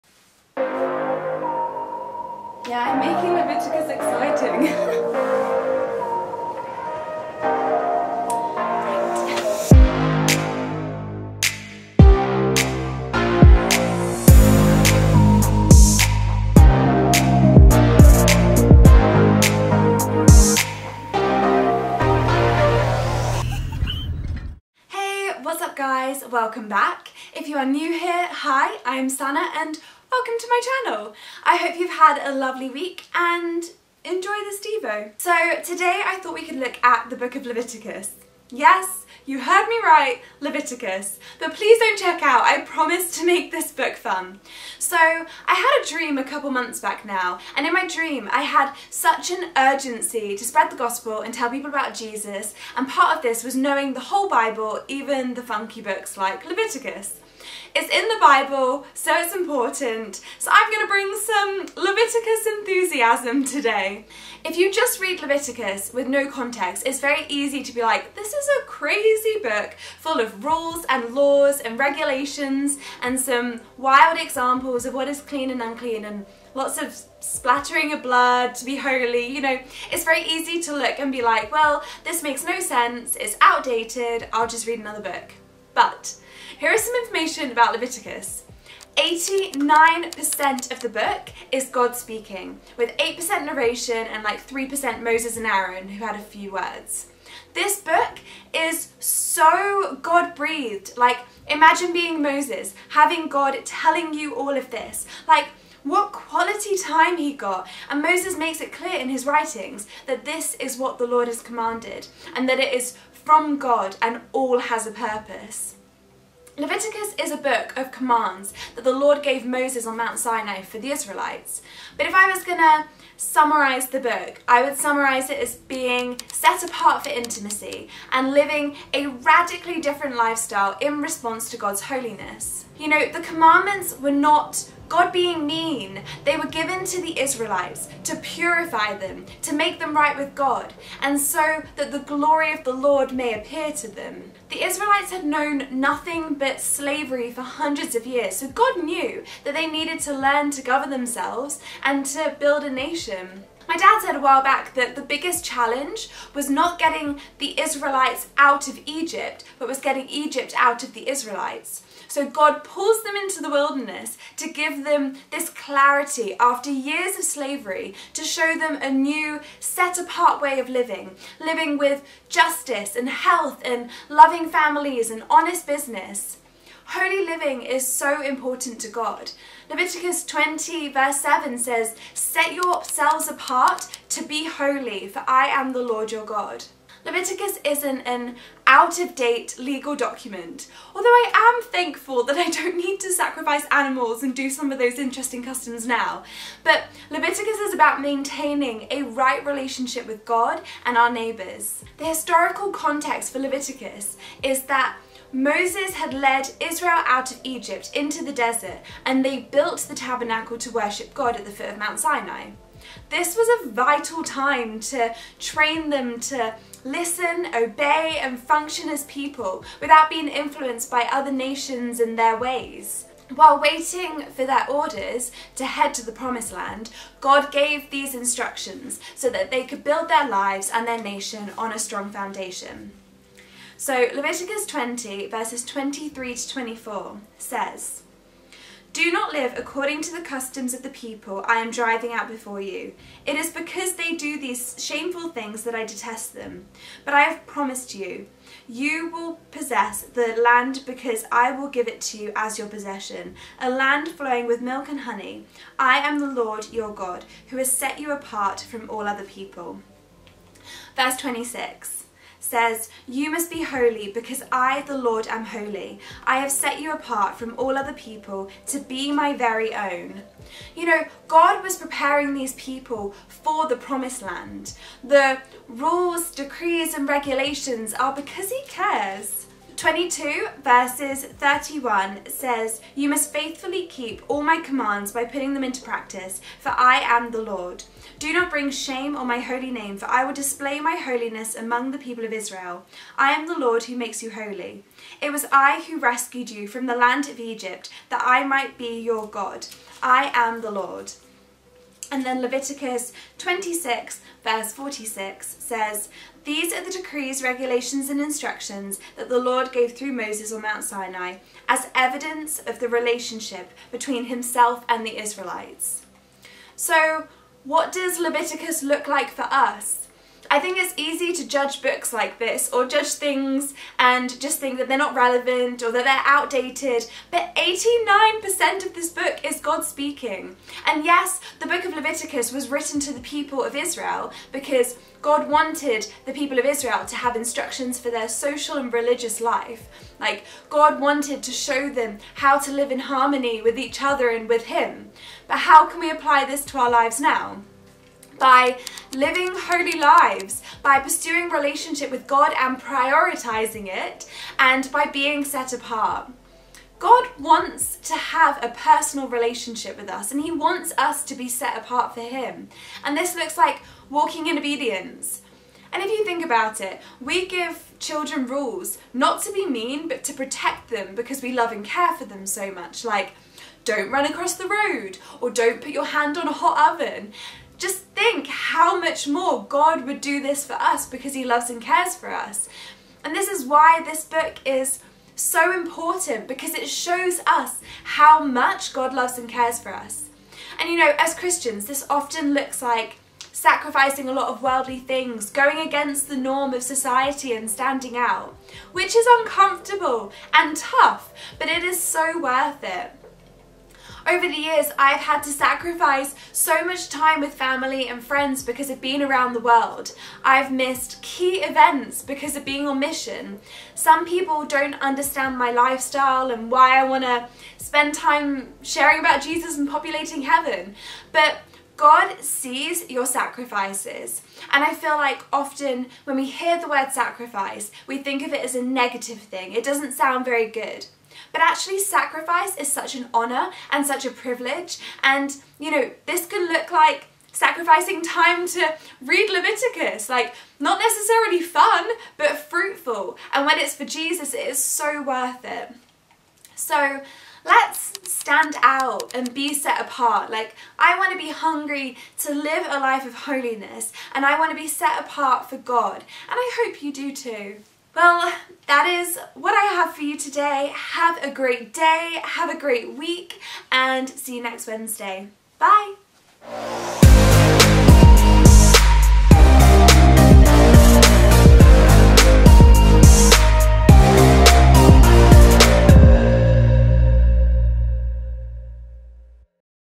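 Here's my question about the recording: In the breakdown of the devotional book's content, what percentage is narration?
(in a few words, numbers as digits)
8%.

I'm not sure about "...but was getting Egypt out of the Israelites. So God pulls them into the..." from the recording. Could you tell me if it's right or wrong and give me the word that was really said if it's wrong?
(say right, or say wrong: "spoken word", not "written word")
right.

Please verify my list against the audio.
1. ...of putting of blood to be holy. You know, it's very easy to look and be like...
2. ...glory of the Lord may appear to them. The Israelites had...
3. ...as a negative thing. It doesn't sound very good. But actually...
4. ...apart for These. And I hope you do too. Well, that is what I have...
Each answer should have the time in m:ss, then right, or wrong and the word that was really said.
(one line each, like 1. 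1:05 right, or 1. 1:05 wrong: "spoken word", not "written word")
1. 1:16 wrong: "splattering", not "putting"
2. 2:21 right
3. 7:08 right
4. 7:35 wrong: "God", not "These".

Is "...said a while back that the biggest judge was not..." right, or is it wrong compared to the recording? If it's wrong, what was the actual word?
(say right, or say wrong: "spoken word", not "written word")
wrong: "challenge", not "judge".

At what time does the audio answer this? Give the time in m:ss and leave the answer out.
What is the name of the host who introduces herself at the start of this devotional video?
0:29.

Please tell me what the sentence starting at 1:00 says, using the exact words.
So I'm going to bring some Leviticus enthusiasm today.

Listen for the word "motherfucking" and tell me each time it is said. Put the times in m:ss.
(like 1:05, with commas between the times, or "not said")
not said.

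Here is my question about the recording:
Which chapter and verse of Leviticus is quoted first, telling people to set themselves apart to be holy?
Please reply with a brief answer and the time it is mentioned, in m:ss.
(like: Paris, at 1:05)
Leviticus 20:7, at 2:59.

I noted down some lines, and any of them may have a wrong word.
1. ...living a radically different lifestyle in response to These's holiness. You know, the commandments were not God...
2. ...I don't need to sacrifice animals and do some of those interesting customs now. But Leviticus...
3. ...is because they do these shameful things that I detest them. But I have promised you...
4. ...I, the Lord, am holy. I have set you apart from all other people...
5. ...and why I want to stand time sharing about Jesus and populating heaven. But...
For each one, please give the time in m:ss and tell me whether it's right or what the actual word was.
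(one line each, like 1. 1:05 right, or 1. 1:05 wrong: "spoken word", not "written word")
1. 2:08 wrong: "God", not "These"
2. 3:12 right
3. 4:03 right
4. 4:24 right
5. 6:56 wrong: "spend", not "stand".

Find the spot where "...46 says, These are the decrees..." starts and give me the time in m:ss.
5:04.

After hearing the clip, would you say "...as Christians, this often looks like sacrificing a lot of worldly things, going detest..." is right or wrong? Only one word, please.
wrong.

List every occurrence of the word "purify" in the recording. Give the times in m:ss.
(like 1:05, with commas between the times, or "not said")
2:18.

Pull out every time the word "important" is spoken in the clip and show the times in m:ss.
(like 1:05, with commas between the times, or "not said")
0:59, 2:58, 6:25.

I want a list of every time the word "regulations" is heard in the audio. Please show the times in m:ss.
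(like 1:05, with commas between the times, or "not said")
1:11, 4:37, 5:07.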